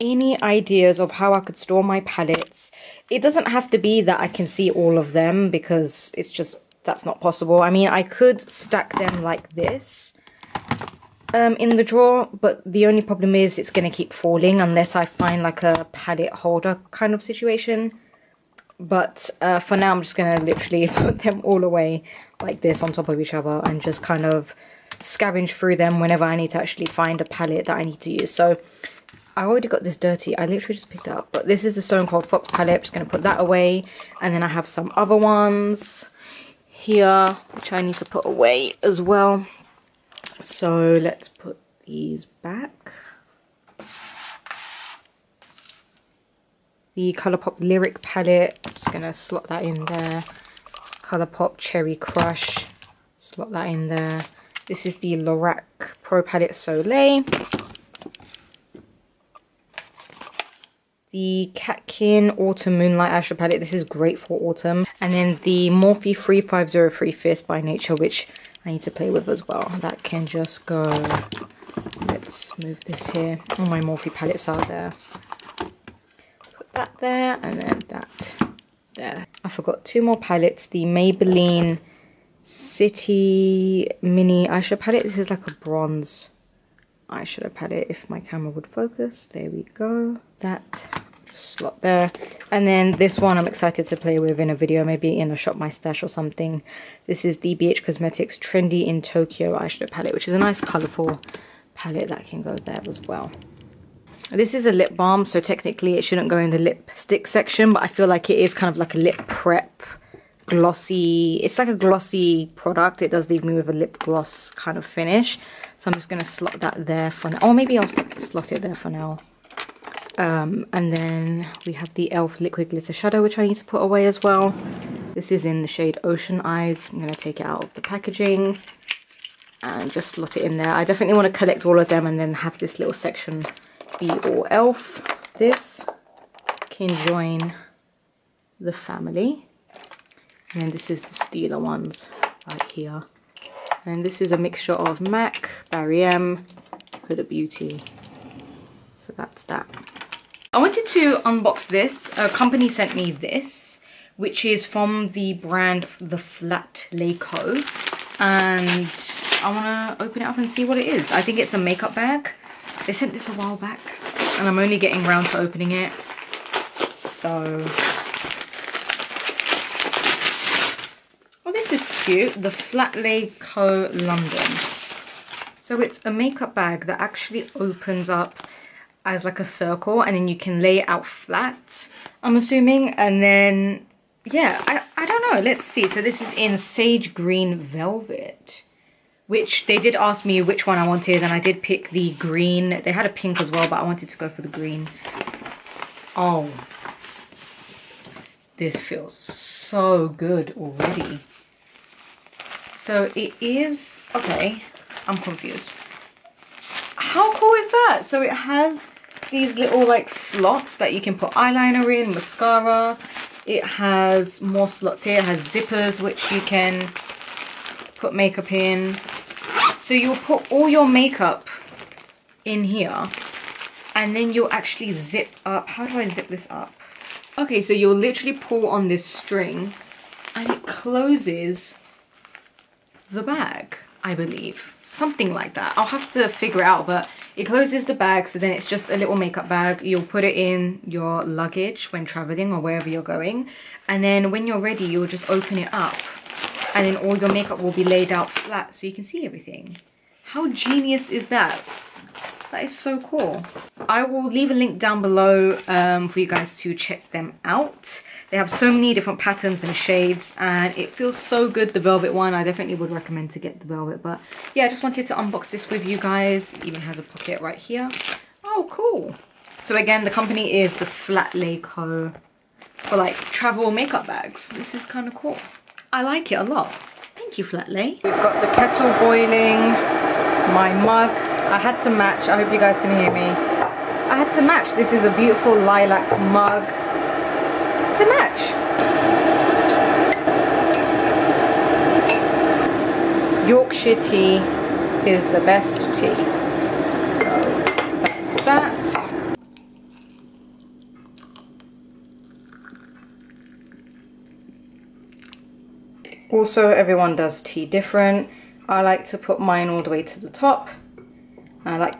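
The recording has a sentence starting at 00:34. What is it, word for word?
And then I have some other ones here, which I need to put away as well.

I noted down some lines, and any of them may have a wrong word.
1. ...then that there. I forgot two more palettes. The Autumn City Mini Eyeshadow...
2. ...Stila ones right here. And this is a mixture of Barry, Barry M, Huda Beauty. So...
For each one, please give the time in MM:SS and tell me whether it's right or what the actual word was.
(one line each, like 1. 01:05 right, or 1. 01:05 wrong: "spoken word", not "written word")
1. 01:17 wrong: "Maybelline", not "Autumn"
2. 02:21 wrong: "MAC", not "Barry".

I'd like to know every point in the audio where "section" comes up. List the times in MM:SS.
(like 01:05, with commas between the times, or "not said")
01:47, 02:12.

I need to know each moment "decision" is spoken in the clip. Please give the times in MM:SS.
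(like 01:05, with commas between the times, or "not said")
not said.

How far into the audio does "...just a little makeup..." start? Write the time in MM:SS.
03:58.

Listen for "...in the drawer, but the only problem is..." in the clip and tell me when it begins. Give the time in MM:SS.
00:11.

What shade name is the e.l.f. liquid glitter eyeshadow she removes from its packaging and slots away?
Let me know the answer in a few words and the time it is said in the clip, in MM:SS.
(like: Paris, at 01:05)
Ocean Eyes, at 02:06.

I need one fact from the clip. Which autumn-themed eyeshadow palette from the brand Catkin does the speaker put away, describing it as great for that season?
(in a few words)
Autumn Moonlight.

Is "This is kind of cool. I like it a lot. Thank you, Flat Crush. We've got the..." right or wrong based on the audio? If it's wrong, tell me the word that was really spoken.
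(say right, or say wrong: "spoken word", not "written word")
wrong: "Lay", not "Crush".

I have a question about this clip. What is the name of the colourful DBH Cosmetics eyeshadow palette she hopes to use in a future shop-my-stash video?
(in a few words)
Trendy in Tokyo.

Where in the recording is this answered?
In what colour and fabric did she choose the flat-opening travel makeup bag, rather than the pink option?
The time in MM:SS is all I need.
03:06.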